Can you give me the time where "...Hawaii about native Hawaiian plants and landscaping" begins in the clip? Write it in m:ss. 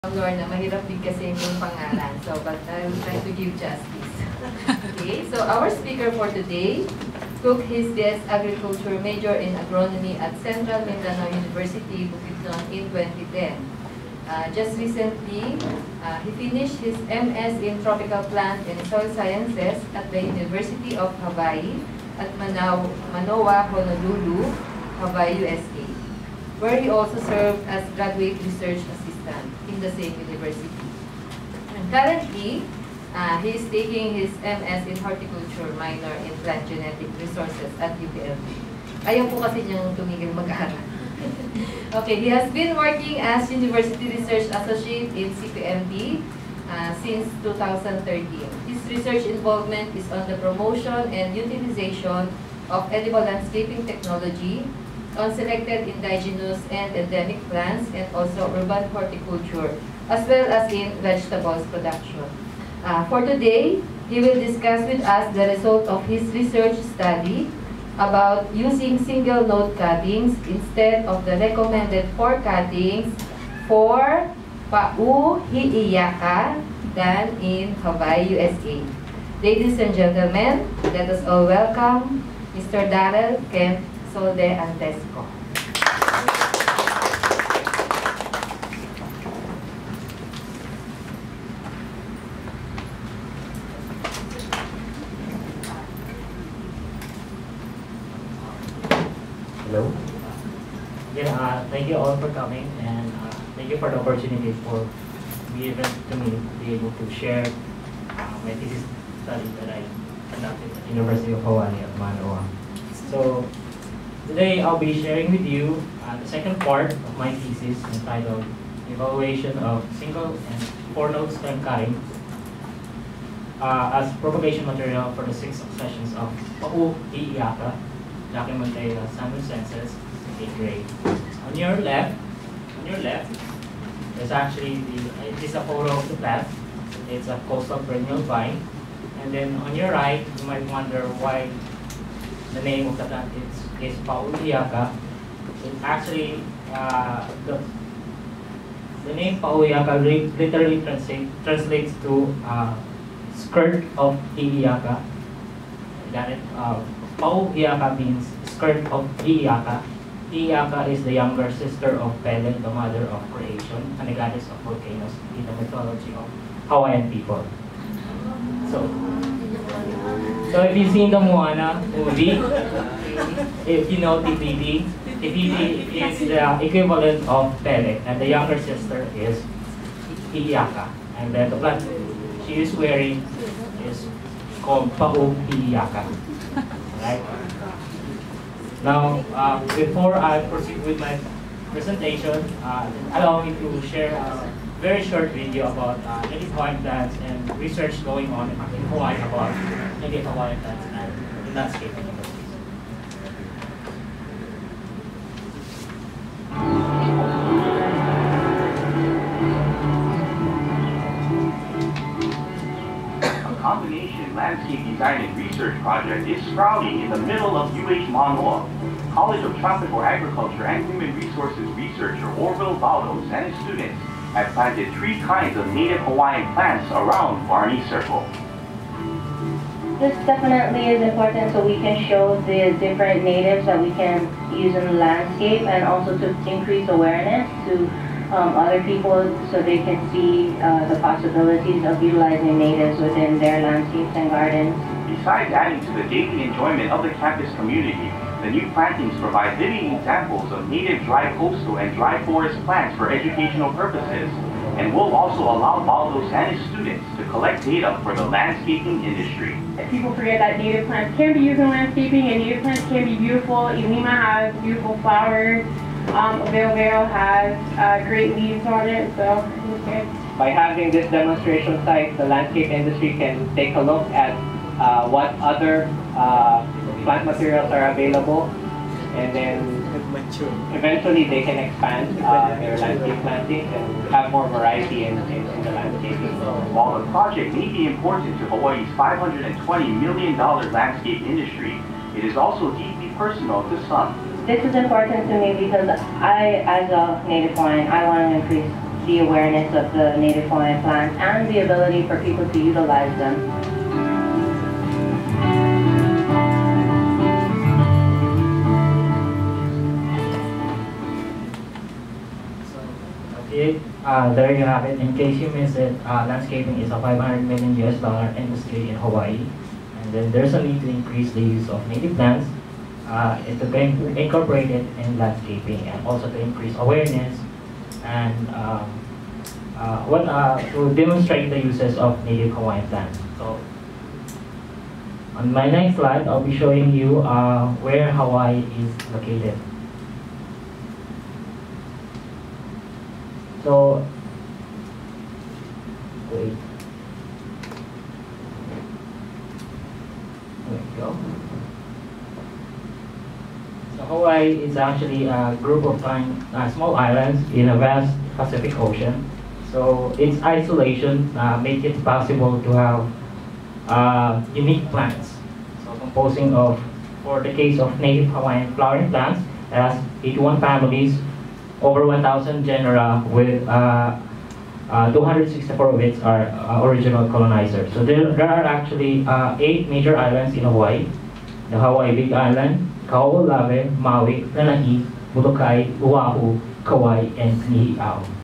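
3:18.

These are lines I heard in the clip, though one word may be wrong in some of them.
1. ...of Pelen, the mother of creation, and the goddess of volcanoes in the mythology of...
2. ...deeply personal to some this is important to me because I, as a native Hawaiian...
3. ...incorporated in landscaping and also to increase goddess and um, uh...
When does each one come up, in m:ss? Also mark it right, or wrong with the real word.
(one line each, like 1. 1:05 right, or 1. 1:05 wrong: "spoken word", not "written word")
1. 2:41 right
2. 4:52 right
3. 5:24 wrong: "awareness", not "goddess".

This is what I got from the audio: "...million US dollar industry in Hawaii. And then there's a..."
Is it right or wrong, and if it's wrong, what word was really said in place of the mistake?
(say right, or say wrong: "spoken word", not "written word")
right.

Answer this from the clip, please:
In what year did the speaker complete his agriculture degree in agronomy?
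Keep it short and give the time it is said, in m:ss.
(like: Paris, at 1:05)
2010, at 0:12.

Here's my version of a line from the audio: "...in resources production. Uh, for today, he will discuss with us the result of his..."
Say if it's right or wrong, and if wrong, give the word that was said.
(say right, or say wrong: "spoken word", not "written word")
wrong: "vegetables", not "resources".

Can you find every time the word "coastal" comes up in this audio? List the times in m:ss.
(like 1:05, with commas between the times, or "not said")
2:17, 4:11.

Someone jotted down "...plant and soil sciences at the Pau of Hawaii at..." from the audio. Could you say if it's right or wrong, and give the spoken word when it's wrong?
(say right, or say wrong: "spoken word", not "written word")
wrong: "University", not "Pau".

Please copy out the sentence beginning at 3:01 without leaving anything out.
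And then the plant she is wearing is called Paung Iliaka.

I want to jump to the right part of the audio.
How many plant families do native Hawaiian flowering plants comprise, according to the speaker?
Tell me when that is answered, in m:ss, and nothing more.
6:10.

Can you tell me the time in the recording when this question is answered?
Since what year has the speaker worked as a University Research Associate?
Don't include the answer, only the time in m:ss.
0:47.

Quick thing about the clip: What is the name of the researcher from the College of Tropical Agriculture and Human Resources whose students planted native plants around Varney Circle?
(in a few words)
Orville Baldos.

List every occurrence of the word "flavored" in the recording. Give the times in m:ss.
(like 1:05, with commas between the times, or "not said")
not said.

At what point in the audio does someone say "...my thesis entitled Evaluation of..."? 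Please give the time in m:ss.
1:57.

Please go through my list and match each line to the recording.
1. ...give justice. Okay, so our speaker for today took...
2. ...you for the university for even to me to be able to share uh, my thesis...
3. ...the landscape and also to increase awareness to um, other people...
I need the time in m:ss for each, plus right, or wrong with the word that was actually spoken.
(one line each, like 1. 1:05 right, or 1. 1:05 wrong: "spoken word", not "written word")
1. 0:03 right
2. 1:43 wrong: "opportunity", not "university"
3. 3:54 right.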